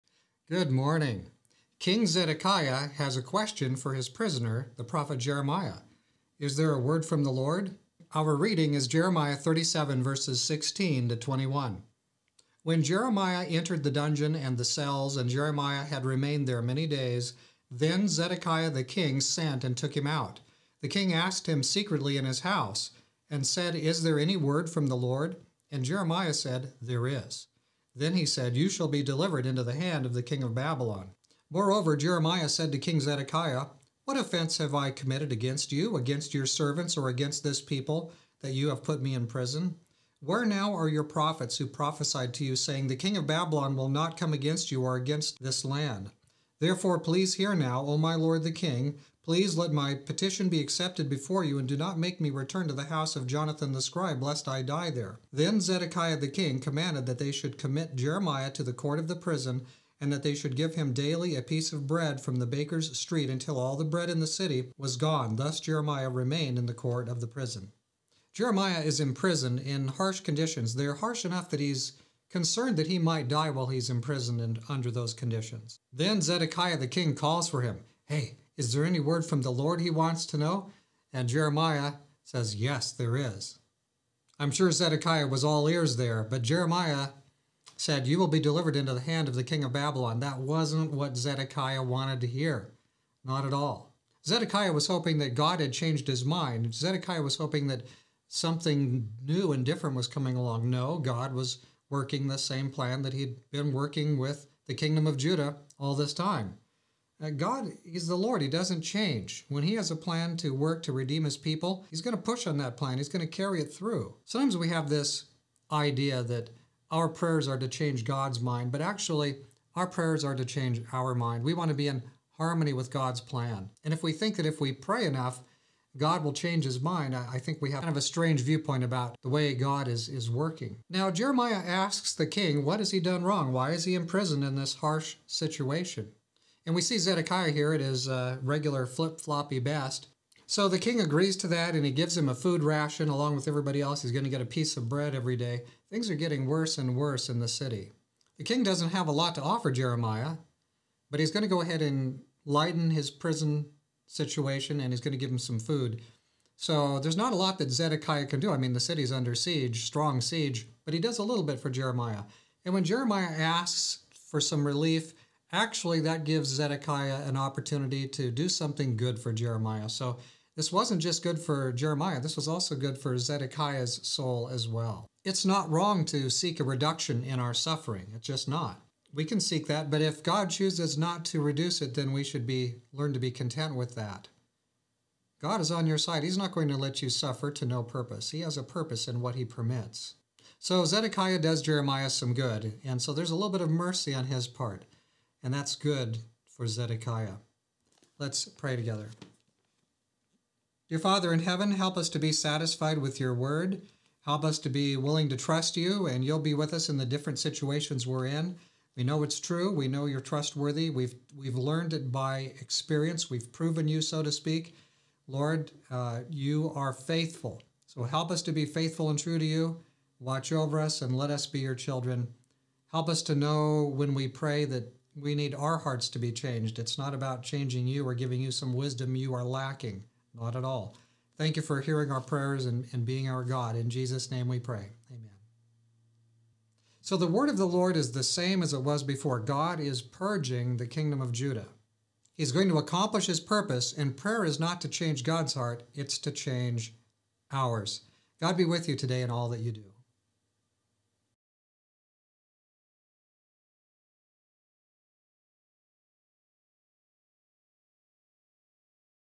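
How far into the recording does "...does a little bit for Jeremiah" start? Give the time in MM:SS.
02:40.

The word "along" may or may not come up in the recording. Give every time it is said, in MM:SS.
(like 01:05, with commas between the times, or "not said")
01:40, 02:23.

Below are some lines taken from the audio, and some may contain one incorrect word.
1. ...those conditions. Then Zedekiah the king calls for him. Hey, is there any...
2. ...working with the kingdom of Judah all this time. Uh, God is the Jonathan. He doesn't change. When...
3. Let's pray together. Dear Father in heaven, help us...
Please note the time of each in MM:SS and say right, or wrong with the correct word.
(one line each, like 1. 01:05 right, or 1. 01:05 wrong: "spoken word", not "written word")
1. 01:14 right
2. 01:43 wrong: "Lord", not "Jonathan"
3. 03:18 right.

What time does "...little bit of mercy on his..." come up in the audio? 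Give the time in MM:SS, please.
03:13.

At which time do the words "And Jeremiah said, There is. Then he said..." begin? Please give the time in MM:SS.
00:25.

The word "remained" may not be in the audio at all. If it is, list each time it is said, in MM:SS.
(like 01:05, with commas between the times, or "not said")
00:16, 01:06.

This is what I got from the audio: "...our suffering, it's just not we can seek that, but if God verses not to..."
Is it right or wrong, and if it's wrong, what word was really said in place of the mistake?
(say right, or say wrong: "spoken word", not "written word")
wrong: "chooses", not "verses".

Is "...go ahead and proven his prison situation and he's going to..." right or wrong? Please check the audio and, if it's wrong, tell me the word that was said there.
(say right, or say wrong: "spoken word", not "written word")
wrong: "lighten", not "proven".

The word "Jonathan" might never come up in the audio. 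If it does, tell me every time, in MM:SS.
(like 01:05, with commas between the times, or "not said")
00:53.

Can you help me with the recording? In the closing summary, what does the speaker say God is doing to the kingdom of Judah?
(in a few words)
Purging.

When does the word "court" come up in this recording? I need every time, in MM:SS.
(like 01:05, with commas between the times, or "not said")
00:58, 01:06.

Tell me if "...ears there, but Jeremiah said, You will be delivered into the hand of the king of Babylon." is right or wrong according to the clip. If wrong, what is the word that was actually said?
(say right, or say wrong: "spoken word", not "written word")
right.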